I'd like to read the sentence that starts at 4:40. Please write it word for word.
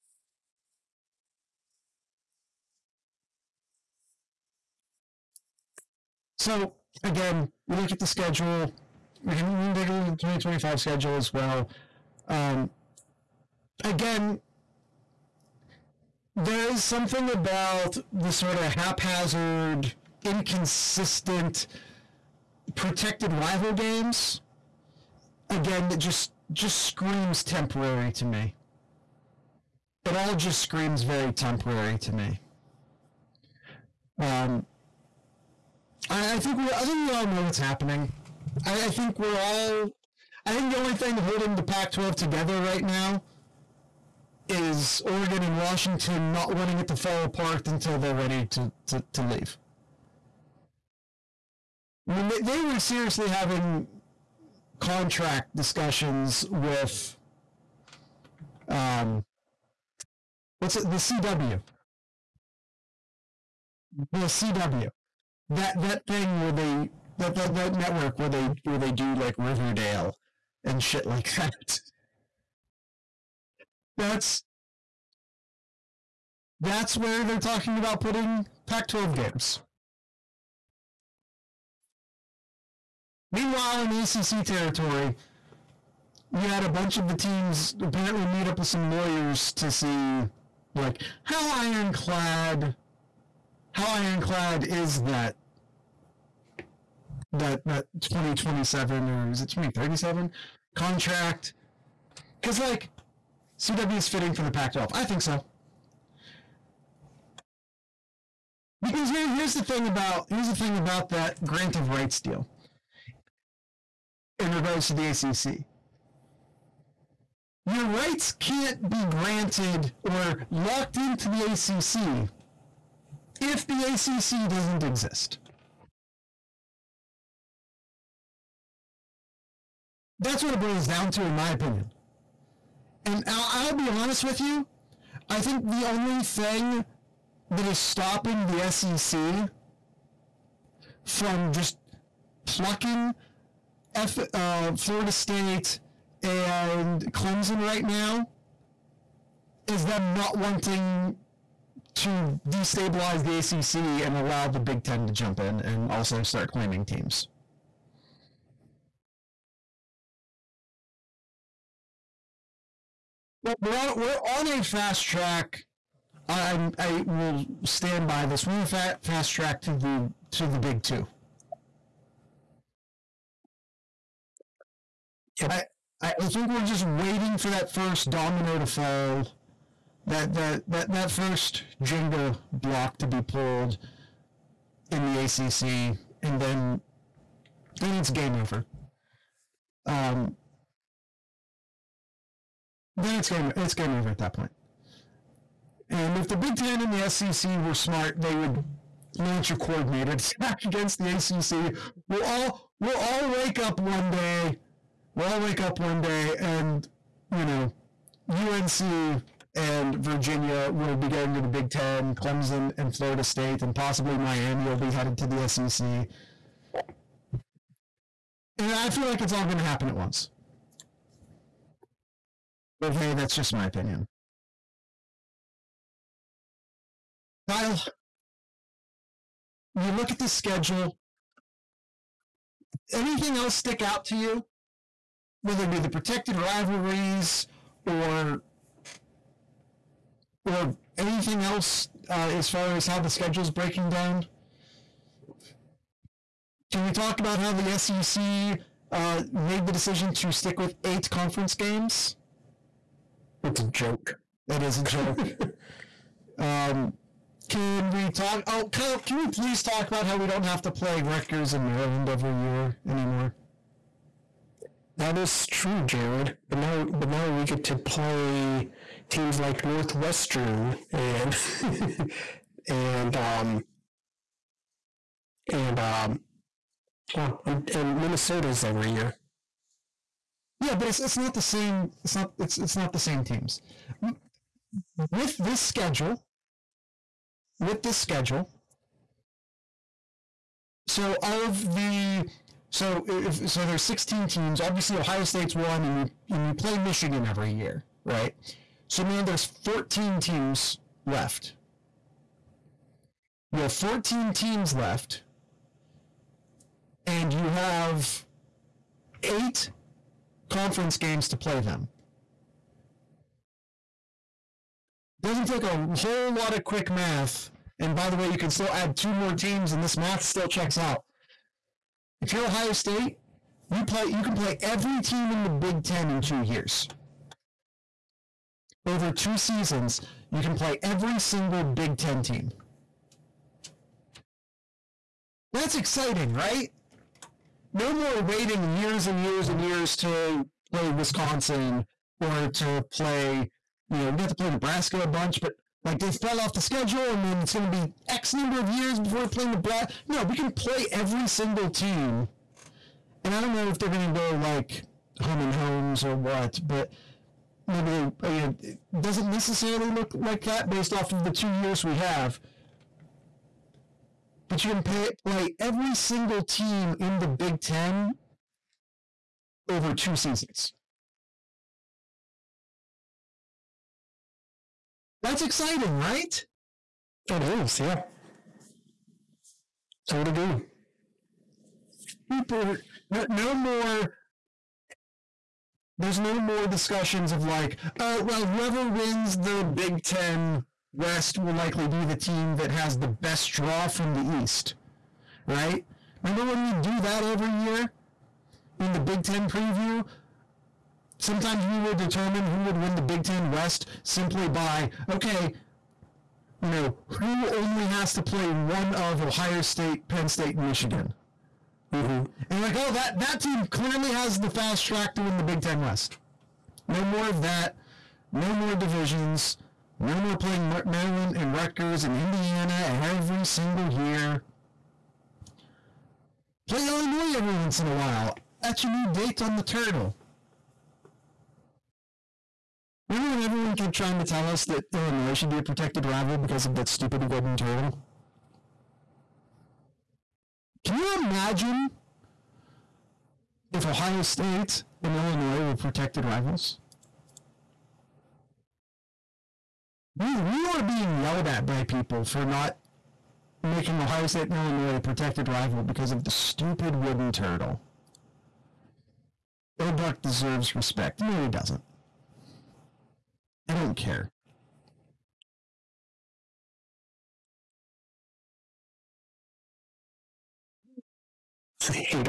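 Yeah, but it's it's not the same.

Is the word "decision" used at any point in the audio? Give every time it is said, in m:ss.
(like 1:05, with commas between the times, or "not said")
4:09.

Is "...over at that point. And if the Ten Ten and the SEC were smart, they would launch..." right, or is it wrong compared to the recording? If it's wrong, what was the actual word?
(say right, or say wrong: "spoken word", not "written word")
wrong: "Big", not "Ten".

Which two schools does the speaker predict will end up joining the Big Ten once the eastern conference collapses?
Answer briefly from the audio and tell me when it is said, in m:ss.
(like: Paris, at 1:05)
UNC and Virginia, at 3:28.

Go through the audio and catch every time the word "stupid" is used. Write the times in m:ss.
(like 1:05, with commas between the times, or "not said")
7:16, 7:36.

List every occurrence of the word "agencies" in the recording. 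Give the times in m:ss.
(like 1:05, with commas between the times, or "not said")
not said.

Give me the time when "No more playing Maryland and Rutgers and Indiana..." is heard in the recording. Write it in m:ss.
6:59.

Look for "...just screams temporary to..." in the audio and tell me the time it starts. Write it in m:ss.
0:26.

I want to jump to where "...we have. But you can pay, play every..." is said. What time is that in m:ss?
6:01.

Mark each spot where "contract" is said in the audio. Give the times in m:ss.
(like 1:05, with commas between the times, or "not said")
0:54, 1:40.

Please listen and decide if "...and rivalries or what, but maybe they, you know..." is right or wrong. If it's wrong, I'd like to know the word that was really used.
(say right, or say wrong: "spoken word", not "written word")
wrong: "homes", not "rivalries".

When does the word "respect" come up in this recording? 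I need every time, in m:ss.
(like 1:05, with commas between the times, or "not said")
7:40.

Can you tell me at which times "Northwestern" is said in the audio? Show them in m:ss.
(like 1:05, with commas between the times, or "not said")
4:29.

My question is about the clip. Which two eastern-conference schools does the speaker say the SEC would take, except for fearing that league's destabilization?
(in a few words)
Florida State and Clemson.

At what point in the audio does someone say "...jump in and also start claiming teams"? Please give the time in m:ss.
2:35.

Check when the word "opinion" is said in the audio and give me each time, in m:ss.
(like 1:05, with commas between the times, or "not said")
2:11, 3:43.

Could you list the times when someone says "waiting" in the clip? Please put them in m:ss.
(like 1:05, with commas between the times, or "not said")
2:56, 5:38.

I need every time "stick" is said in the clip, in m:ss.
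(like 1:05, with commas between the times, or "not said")
3:53, 4:10.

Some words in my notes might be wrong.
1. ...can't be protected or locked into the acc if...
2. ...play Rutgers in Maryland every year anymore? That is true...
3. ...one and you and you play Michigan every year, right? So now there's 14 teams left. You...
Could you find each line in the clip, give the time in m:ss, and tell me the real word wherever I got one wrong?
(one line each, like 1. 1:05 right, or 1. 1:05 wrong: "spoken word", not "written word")
1. 1:58 wrong: "granted", not "protected"
2. 4:20 right
3. 4:55 right.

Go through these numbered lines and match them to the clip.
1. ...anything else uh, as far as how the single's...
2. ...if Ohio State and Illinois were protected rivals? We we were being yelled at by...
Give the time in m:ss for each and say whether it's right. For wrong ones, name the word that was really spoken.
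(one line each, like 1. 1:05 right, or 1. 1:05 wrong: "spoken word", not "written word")
1. 4:00 wrong: "schedule", not "single"
2. 7:23 right.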